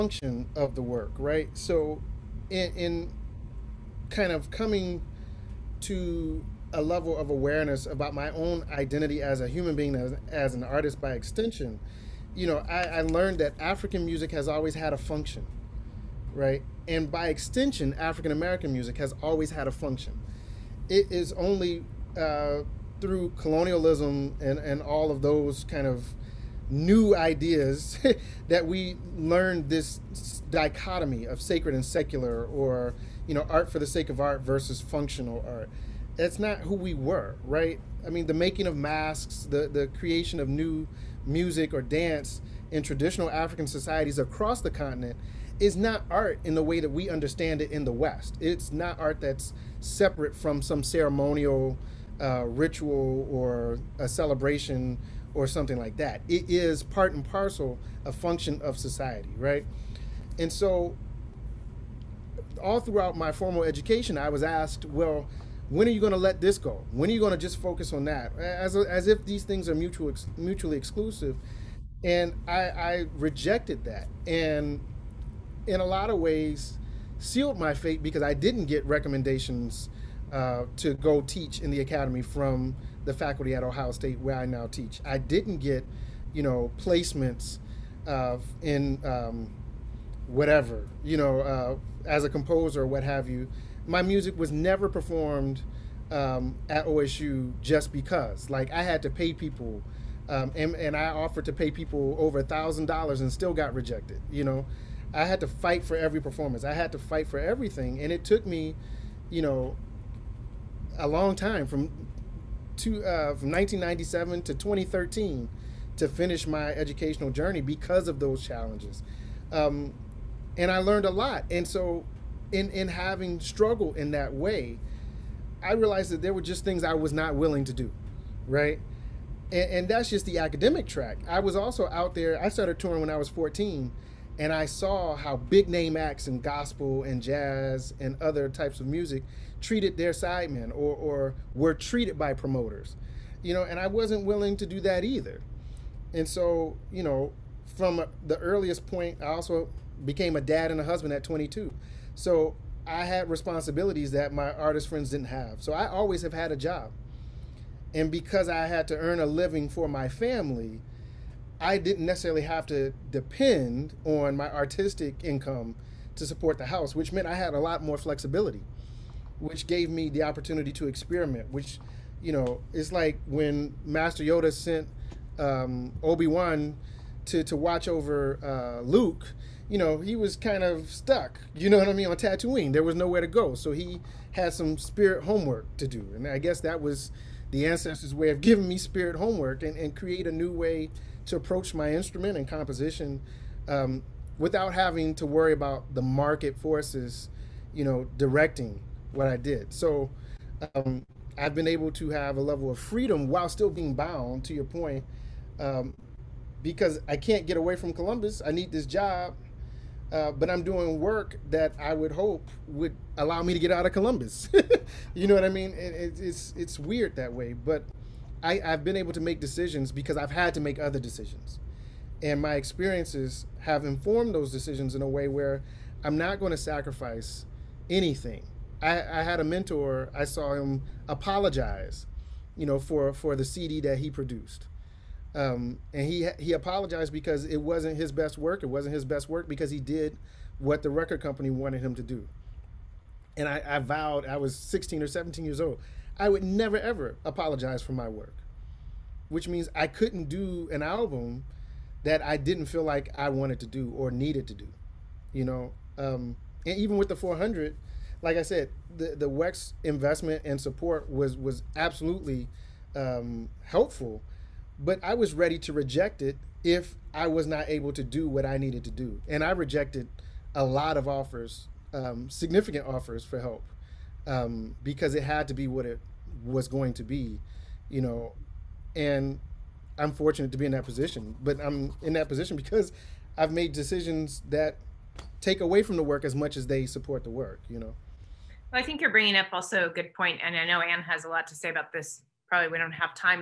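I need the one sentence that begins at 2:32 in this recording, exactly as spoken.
So I had responsibilities that my artist friends didn't have.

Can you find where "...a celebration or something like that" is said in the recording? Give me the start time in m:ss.
0:53.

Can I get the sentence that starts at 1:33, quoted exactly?
My music was never performed um, at OSU just because.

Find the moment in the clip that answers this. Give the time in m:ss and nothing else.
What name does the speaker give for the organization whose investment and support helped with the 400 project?
4:19.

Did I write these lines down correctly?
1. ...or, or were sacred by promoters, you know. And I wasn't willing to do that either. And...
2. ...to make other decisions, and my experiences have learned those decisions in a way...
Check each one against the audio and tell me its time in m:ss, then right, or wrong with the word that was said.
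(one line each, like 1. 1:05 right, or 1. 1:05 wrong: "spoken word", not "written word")
1. 2:20 wrong: "treated", not "sacred"
2. 3:40 wrong: "informed", not "learned".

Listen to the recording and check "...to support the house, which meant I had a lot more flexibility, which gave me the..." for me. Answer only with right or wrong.
right.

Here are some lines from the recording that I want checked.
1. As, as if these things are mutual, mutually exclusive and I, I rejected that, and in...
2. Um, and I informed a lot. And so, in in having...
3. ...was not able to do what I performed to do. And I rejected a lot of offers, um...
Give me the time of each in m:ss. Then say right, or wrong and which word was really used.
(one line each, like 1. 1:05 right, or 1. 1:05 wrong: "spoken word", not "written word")
1. 1:08 right
2. 1:59 wrong: "learned", not "informed"
3. 4:27 wrong: "needed", not "performed".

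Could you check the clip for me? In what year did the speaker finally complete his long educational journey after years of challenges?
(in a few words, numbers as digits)
2013.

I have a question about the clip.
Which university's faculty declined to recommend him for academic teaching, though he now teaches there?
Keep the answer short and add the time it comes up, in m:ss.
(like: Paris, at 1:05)
Ohio State, at 1:23.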